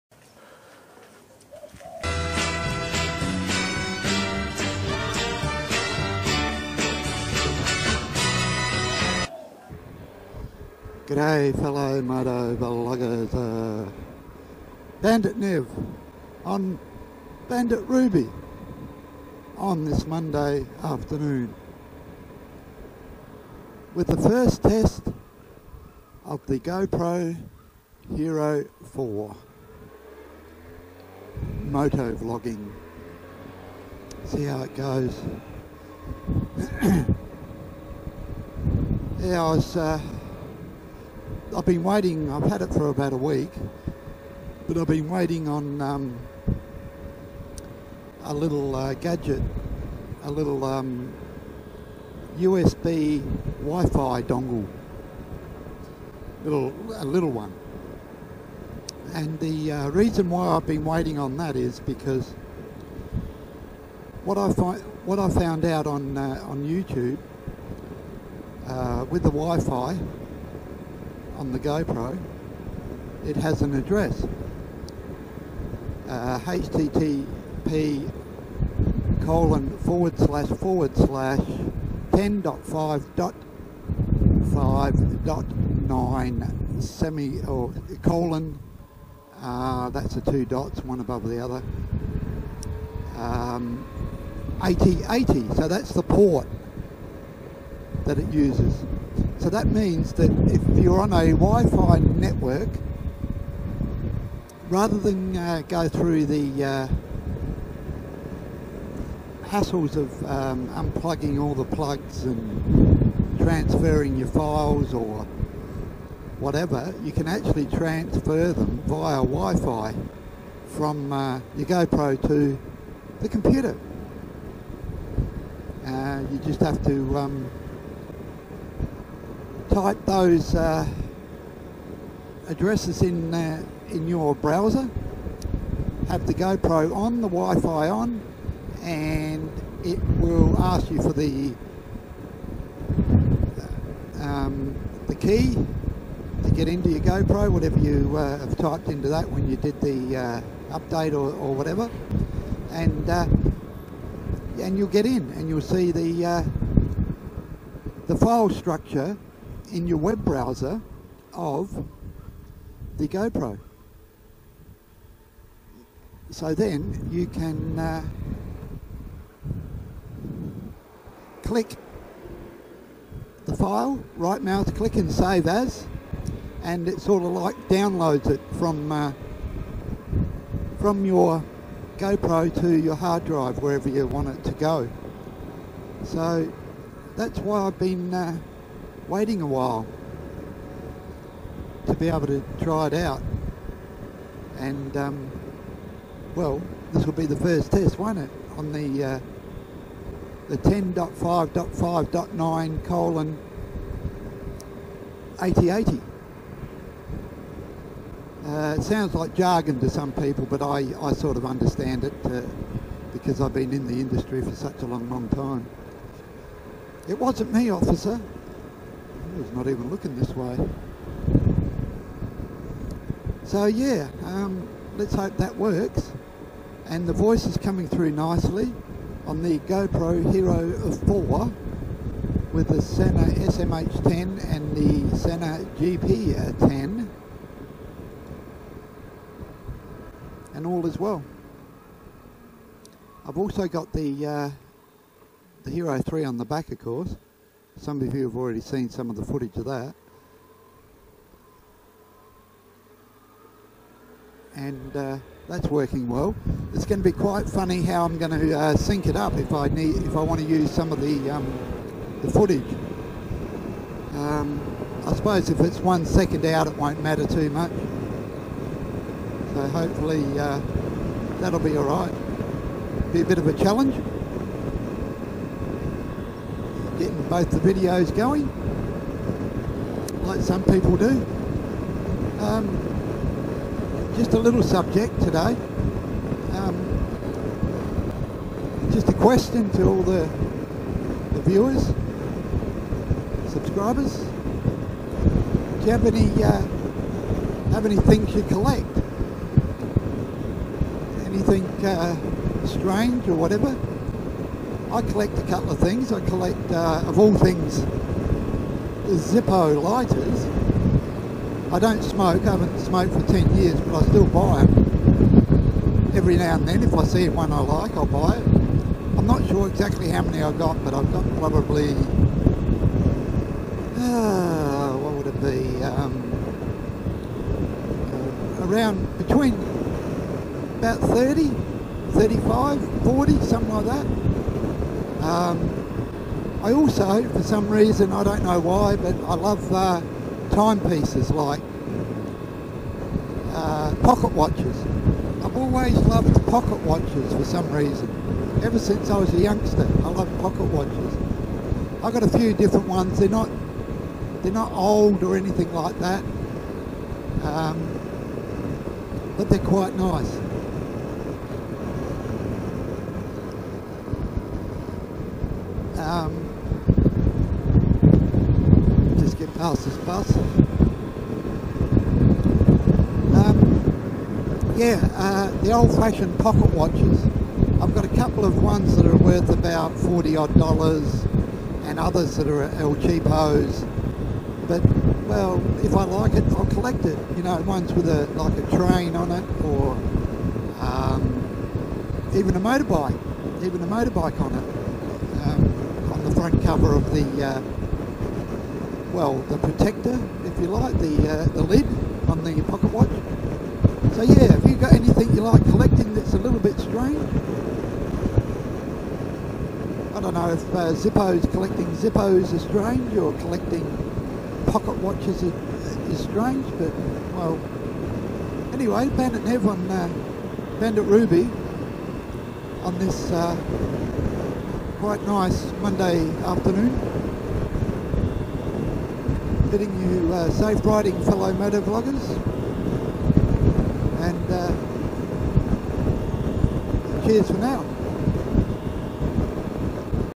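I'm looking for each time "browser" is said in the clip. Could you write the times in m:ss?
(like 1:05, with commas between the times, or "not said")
2:14, 2:40.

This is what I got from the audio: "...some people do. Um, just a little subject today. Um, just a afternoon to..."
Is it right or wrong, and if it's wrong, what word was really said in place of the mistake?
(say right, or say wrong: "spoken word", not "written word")
wrong: "question", not "afternoon".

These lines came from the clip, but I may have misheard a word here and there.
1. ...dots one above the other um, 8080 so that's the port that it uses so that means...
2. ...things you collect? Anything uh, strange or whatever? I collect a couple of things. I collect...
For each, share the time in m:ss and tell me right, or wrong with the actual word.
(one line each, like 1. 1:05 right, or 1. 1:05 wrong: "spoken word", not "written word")
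1. 1:30 right
2. 4:57 right.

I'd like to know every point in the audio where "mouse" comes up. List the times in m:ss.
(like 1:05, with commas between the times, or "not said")
2:54.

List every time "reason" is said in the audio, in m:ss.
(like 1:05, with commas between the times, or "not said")
0:59, 5:37, 5:47.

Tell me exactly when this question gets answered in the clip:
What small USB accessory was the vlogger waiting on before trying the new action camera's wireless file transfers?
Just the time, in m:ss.
0:52.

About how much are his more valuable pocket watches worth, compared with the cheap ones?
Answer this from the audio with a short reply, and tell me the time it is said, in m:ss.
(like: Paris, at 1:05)
$40, at 6:19.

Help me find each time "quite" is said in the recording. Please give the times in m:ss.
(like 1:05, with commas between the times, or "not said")
4:17, 5:59, 7:05.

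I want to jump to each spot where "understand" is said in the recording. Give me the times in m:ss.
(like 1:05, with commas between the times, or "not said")
3:31.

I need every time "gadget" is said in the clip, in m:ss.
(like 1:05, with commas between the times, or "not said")
0:48.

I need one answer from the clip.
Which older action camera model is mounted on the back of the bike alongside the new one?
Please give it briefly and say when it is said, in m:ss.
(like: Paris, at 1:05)
Hero 3, at 4:05.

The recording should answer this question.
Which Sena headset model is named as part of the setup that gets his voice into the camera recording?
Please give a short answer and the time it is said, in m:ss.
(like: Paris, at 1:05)
Sena SMH10, at 3:52.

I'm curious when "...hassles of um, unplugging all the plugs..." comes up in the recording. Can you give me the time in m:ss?
1:49.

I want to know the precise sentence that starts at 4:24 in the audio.
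Um, I suppose if it's one second out, it won't matter too much.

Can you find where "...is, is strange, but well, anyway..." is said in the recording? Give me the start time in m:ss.
6:55.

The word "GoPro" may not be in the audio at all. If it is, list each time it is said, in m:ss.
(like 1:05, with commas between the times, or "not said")
0:26, 1:11, 2:01, 2:16, 2:26, 2:43, 3:01, 3:49.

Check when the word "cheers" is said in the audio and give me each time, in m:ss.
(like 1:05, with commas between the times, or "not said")
7:17.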